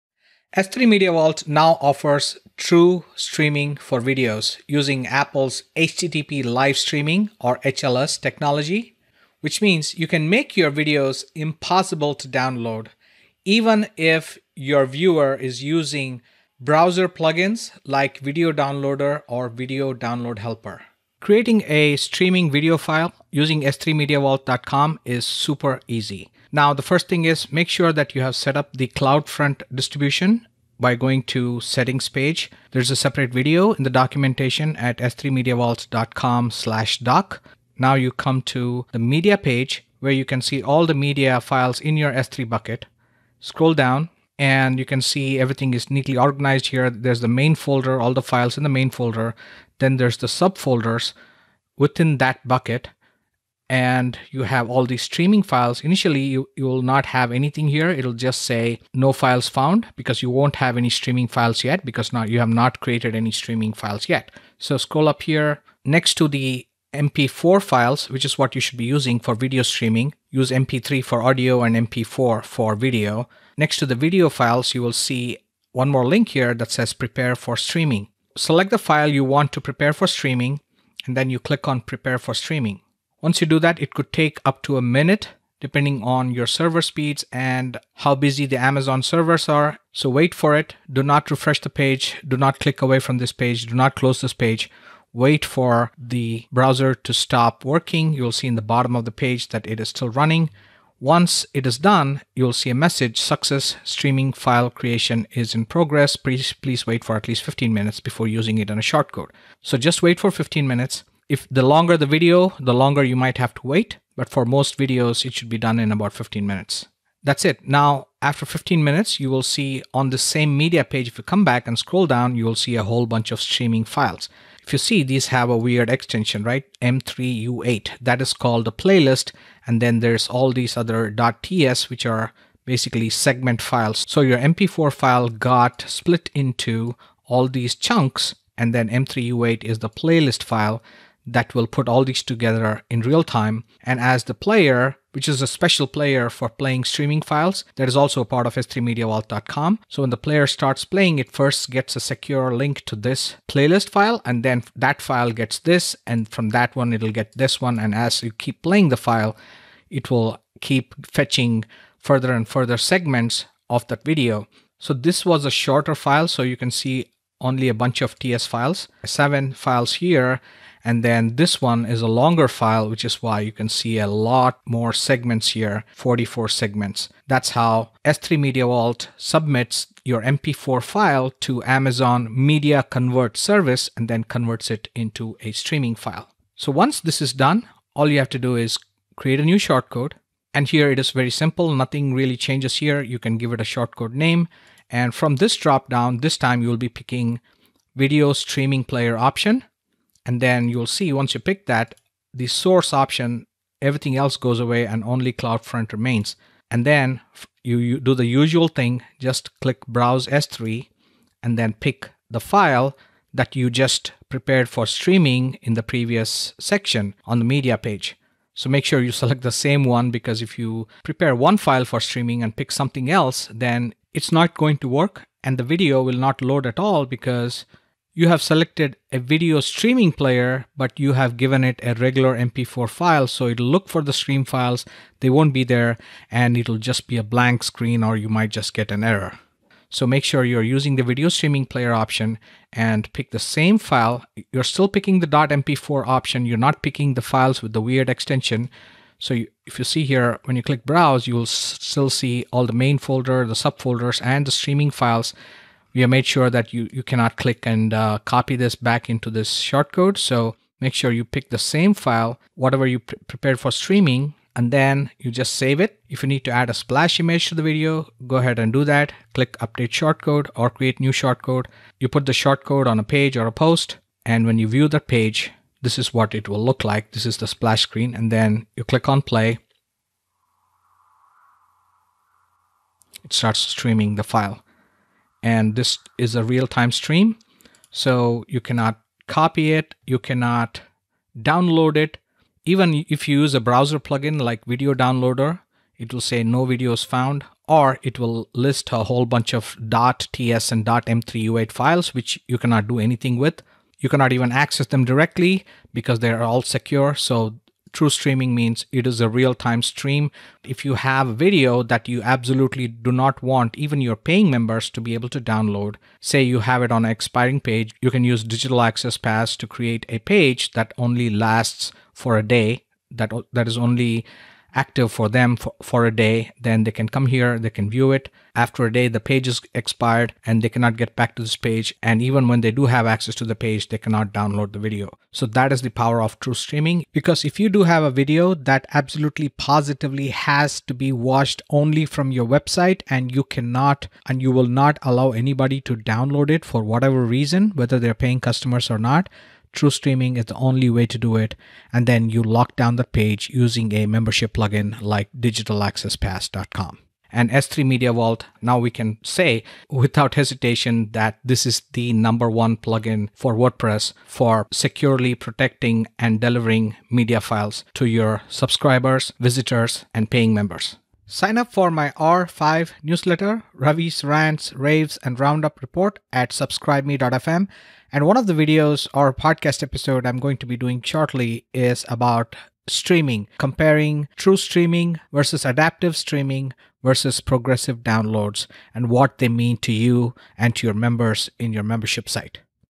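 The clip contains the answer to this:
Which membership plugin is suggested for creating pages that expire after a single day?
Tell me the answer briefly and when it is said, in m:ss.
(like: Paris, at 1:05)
Digital Access Pass, at 5:18.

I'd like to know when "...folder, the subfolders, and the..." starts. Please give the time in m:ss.
4:12.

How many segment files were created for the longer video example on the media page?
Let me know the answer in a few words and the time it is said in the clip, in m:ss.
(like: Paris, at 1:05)
44, at 2:55.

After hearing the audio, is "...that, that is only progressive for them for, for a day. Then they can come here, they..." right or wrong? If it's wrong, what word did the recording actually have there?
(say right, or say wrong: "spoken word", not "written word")
wrong: "active", not "progressive".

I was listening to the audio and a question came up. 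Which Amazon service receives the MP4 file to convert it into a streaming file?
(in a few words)
Amazon Media Convert.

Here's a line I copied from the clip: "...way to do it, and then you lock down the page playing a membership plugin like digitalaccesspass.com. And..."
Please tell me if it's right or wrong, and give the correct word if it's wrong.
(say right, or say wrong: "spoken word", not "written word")
wrong: "using", not "playing".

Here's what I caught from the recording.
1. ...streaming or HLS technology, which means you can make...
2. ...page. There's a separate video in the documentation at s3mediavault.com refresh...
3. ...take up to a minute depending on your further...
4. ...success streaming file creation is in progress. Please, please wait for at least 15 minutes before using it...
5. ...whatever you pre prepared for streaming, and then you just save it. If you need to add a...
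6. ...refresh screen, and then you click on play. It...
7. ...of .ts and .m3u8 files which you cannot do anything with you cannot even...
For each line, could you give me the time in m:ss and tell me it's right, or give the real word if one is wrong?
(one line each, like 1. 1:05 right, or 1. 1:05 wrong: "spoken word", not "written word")
1. 0:06 right
2. 0:32 wrong: "slash", not "refresh"
3. 1:24 wrong: "server", not "further"
4. 1:43 right
5. 4:22 right
6. 4:37 wrong: "splash", not "refresh"
7. 4:59 right.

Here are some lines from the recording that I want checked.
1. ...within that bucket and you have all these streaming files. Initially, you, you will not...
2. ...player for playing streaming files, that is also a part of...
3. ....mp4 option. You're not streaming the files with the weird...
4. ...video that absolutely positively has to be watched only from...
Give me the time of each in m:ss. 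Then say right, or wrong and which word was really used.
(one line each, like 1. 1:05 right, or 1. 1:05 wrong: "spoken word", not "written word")
1. 0:51 right
2. 2:25 right
3. 4:05 wrong: "picking", not "streaming"
4. 5:38 right.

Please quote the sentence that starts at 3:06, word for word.
So once this is done, all you have to do is create a new shortcode.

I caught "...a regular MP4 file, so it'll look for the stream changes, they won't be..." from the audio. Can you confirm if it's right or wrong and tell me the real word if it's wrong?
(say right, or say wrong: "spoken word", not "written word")
wrong: "files", not "changes".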